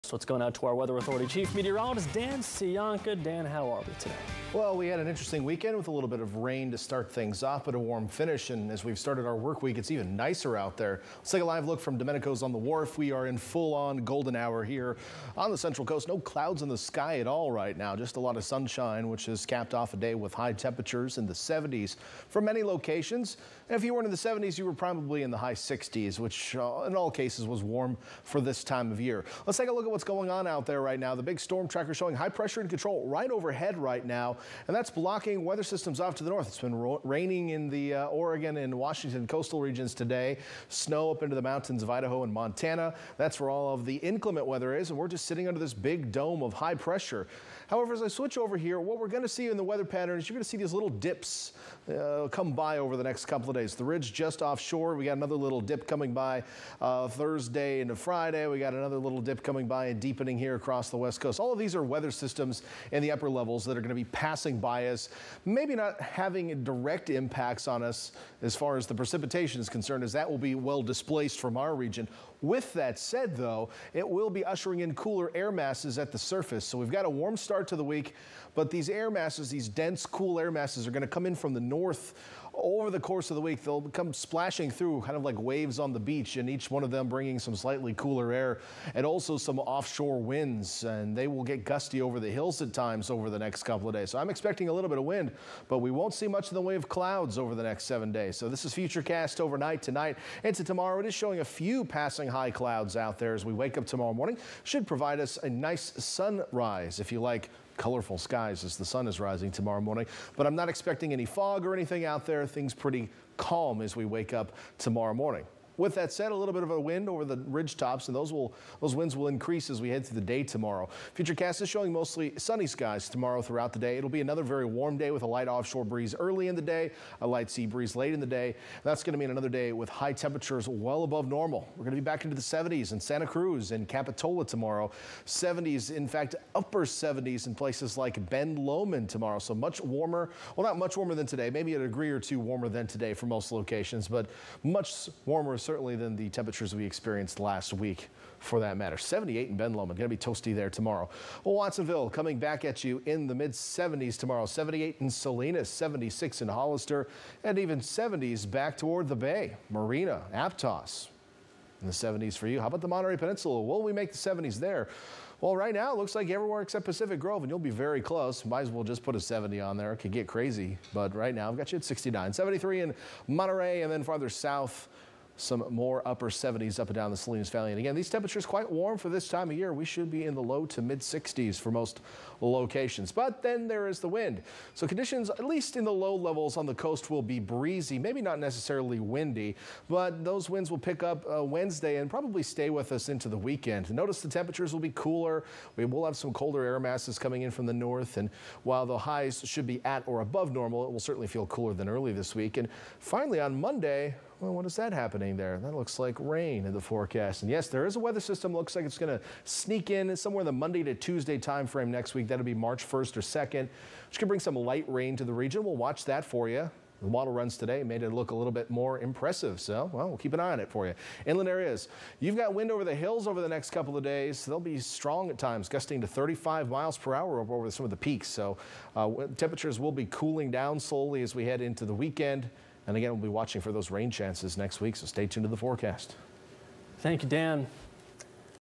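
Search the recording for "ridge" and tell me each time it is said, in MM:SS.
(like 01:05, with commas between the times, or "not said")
00:53, 01:57.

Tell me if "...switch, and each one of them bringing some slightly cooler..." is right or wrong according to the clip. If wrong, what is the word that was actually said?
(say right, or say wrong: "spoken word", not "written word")
wrong: "beach", not "switch".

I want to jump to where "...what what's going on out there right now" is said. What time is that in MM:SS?
00:29.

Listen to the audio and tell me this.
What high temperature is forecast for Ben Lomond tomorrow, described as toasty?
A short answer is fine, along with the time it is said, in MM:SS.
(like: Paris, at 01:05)
78, at 02:28.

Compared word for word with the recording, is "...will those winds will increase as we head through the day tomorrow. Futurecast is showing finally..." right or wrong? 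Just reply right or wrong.
wrong.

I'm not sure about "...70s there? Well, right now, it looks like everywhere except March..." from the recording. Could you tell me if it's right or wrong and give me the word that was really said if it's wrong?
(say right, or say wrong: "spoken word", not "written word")
wrong: "Pacific", not "March".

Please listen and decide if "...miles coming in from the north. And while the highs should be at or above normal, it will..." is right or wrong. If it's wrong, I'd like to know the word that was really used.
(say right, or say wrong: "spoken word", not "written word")
wrong: "masses", not "miles".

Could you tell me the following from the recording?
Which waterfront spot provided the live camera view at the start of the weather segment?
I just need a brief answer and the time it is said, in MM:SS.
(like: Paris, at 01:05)
Domenico's on the wharf, at 00:11.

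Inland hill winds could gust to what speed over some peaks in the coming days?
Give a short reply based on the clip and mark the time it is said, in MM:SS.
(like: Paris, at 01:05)
35 mph, at 03:46.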